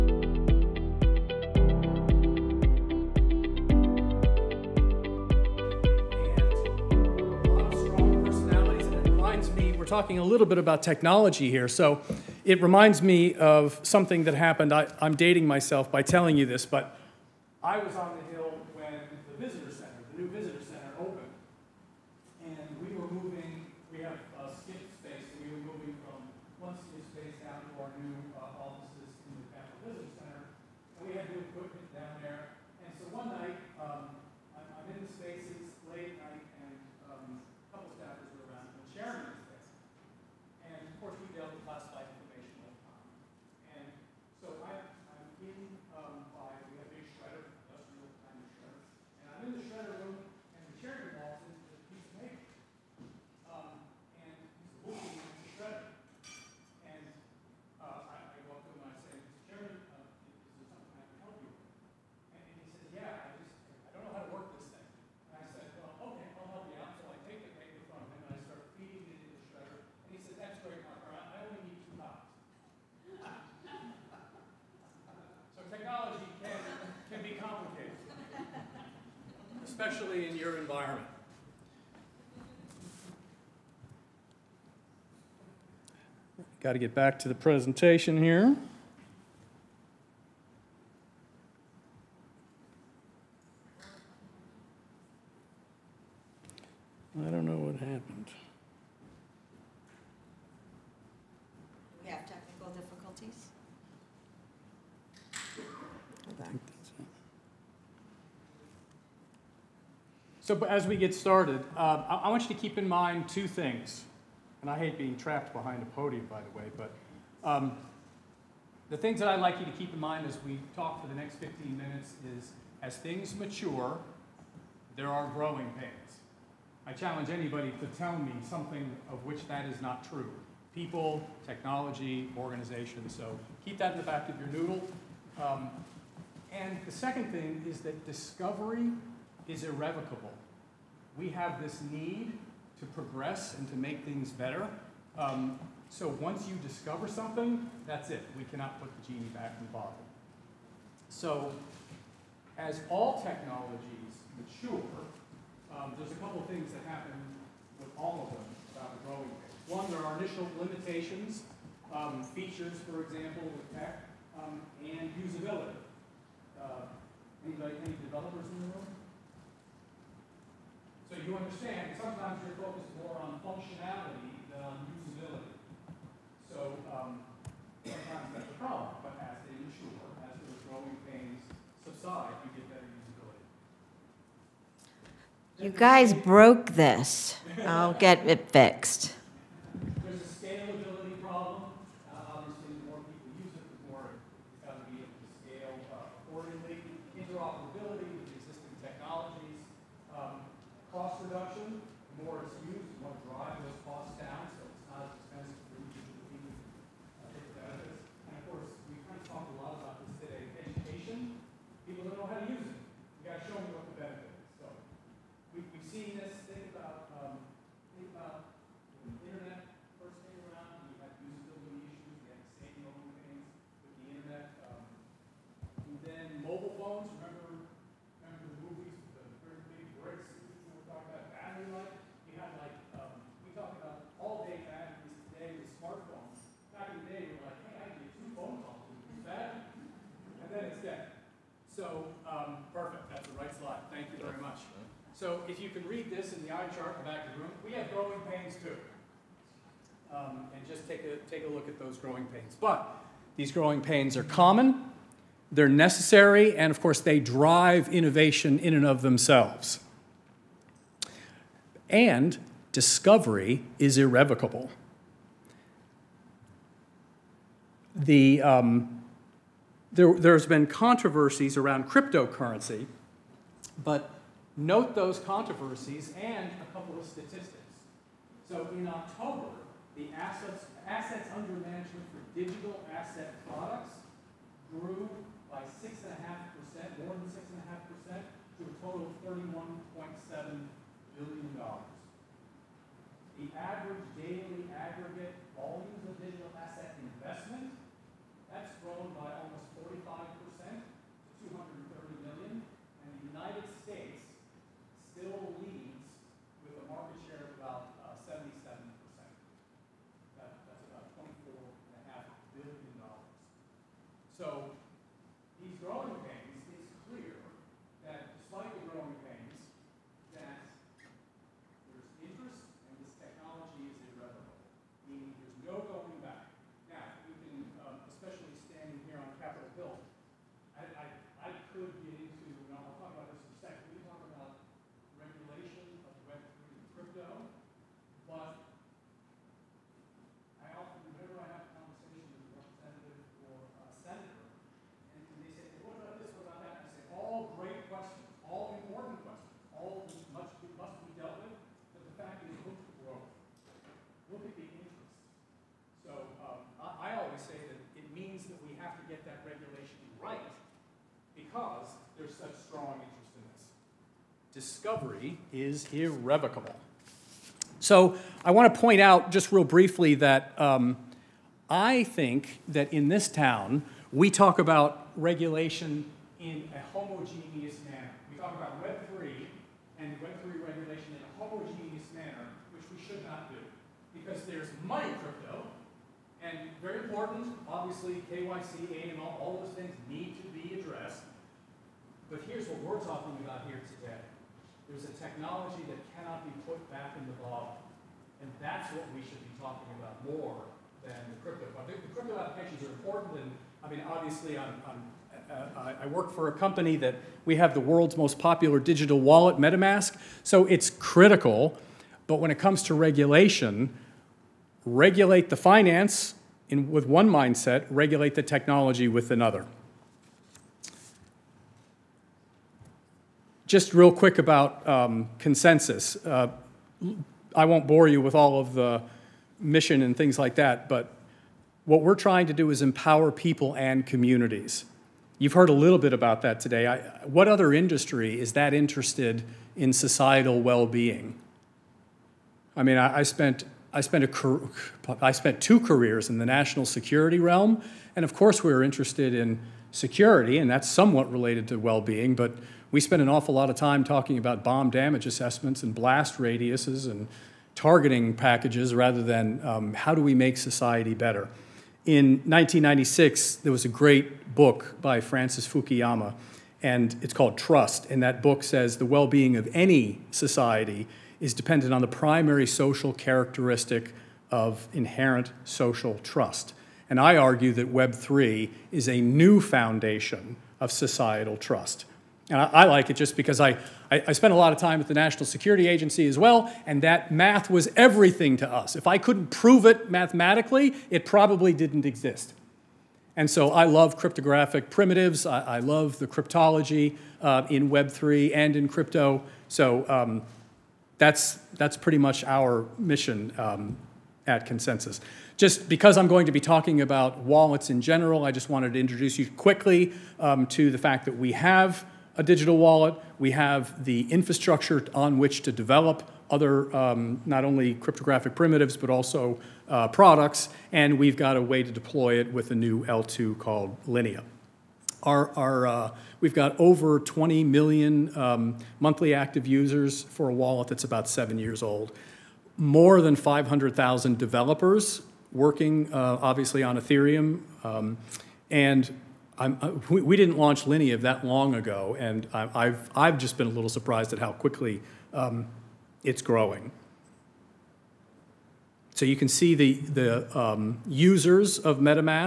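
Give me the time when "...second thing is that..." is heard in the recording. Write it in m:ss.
2:16.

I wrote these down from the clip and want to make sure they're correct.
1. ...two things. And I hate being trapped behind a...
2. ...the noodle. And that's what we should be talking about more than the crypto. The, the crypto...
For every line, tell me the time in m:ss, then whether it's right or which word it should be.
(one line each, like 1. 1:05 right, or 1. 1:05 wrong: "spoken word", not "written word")
1. 1:53 right
2. 6:37 wrong: "bottle", not "noodle".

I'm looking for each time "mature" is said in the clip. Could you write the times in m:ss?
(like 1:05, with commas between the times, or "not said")
2:03, 2:34, 2:59.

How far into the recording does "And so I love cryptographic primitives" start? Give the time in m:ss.
8:13.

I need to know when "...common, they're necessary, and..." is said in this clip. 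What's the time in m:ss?
4:14.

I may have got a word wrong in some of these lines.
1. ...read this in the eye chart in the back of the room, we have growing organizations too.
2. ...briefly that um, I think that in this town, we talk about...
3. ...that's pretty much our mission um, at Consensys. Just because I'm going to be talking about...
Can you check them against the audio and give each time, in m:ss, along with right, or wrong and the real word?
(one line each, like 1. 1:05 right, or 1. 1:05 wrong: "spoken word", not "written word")
1. 4:05 wrong: "pains", not "organizations"
2. 6:09 right
3. 8:21 right.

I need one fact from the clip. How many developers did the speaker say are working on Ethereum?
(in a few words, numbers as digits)
more than 500,000.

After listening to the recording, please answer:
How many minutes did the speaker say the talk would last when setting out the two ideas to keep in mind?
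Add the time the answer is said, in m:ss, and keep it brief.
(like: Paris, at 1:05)
15, at 2:01.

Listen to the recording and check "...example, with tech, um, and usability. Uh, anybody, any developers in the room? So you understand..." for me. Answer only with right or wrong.
right.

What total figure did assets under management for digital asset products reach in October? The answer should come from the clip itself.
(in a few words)
$31.7 billion.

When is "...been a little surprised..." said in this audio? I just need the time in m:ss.
9:03.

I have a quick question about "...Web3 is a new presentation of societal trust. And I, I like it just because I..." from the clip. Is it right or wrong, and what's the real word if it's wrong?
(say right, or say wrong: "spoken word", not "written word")
wrong: "foundation", not "presentation".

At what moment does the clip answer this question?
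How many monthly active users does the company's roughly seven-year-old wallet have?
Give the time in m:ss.
8:46.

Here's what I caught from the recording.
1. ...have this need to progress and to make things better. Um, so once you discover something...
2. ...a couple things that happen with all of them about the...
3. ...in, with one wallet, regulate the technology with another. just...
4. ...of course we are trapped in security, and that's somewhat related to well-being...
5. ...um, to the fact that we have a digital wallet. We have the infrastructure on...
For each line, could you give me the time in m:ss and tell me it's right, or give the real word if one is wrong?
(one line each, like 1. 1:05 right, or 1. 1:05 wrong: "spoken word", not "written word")
1. 2:21 right
2. 2:36 right
3. 6:56 wrong: "mindset", not "wallet"
4. 7:28 wrong: "interested", not "trapped"
5. 8:30 right.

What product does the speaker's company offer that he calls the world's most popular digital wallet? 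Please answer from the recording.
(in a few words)
MetaMask.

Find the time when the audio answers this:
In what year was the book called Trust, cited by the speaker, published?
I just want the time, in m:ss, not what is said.
7:42.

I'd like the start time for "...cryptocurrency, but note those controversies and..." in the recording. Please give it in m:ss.
4:31.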